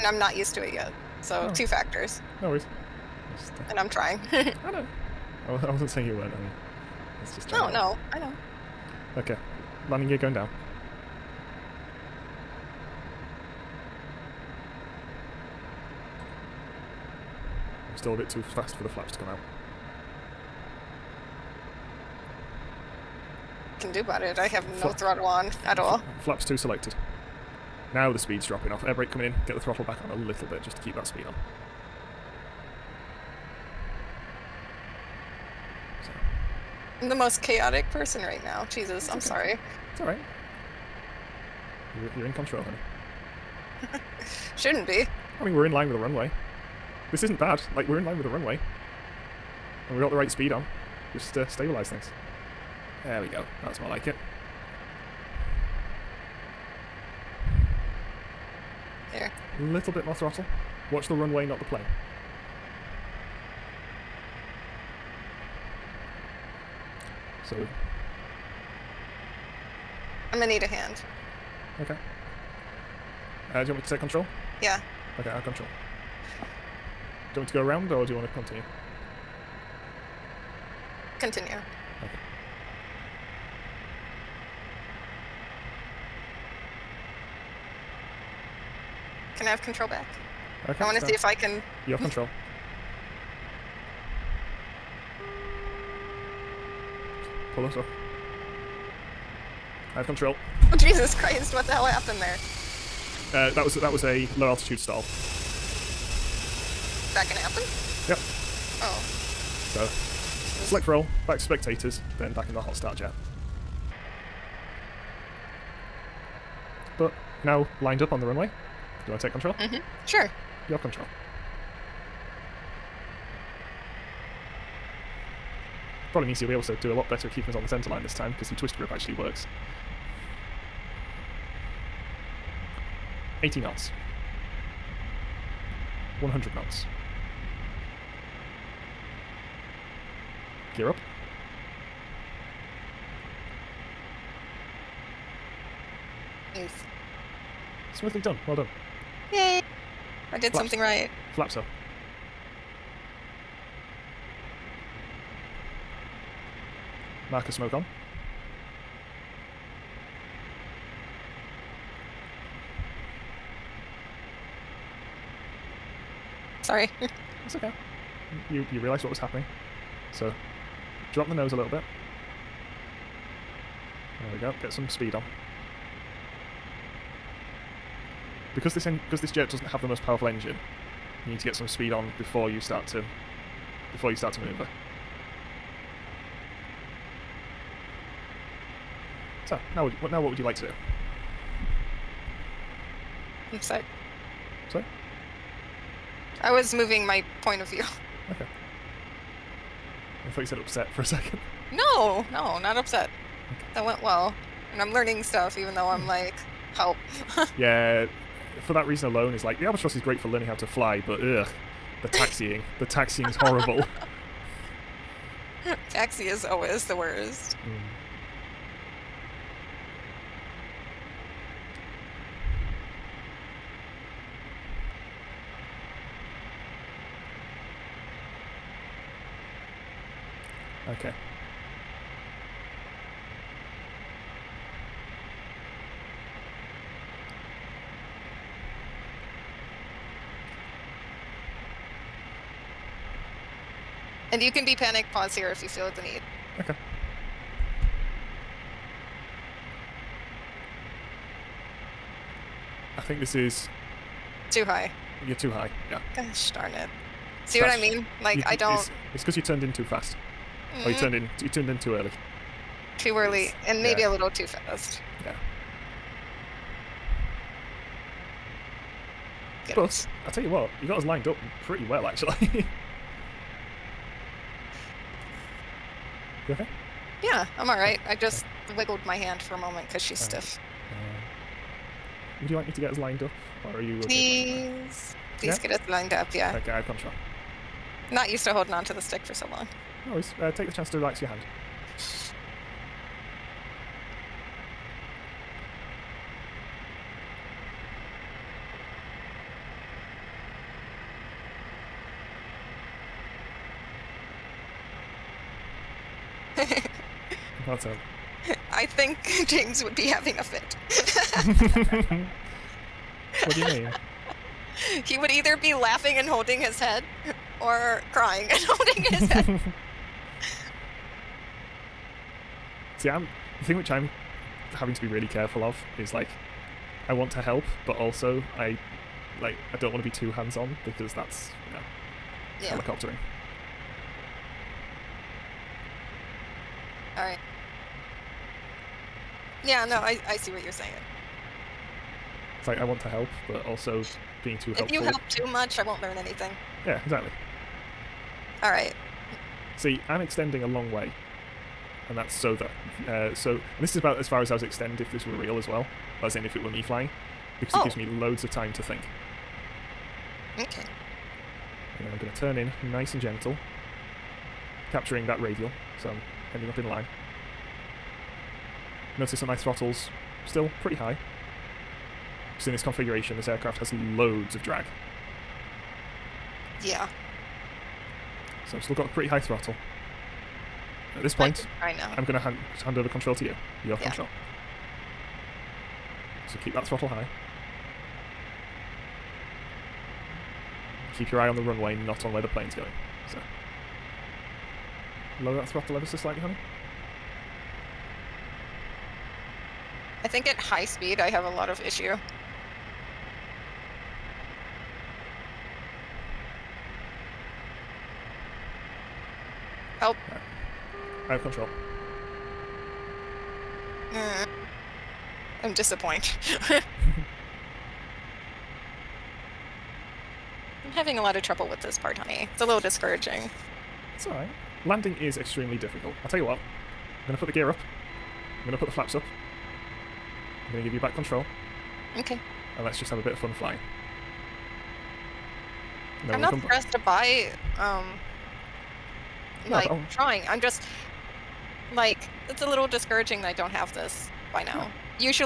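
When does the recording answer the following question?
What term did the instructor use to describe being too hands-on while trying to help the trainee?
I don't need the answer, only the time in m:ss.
5:32.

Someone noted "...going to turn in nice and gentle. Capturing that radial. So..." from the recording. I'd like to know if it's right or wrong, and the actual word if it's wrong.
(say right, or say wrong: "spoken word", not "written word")
right.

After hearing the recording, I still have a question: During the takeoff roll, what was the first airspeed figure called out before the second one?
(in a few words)
80 knots.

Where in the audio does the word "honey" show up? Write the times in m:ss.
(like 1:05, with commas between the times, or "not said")
0:42, 6:36, 7:02.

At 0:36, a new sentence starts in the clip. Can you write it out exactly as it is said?
I'm the most chaotic person right now.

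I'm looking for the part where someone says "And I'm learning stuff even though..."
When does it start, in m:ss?
3:24.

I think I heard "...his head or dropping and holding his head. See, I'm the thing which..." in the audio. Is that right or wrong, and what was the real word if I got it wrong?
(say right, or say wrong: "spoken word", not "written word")
wrong: "crying", not "dropping".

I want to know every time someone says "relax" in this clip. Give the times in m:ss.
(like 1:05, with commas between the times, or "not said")
4:50.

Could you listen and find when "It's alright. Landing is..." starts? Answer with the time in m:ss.
7:04.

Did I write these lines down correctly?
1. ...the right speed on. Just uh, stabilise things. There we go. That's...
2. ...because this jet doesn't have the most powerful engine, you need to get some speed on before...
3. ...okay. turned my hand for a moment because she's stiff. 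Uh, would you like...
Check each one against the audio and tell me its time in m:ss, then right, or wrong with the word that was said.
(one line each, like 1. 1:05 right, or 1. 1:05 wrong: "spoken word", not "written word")
1. 0:50 right
2. 2:58 right
3. 4:38 wrong: "wiggled", not "turned".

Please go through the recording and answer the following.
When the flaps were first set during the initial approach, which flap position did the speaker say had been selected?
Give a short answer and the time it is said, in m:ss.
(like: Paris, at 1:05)
Flaps 2, at 0:26.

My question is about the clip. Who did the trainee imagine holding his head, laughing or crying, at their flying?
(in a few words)
James.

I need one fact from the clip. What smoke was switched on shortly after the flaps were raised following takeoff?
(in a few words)
Marker smoke.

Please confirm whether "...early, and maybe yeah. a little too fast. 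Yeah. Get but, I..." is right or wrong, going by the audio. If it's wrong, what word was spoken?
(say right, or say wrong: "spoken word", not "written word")
right.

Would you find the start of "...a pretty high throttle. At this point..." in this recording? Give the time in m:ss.
6:19.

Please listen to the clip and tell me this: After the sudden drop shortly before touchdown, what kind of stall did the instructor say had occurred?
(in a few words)
Low altitude stall.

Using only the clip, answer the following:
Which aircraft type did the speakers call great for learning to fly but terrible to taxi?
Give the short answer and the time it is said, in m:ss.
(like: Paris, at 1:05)
Albatros, at 3:29.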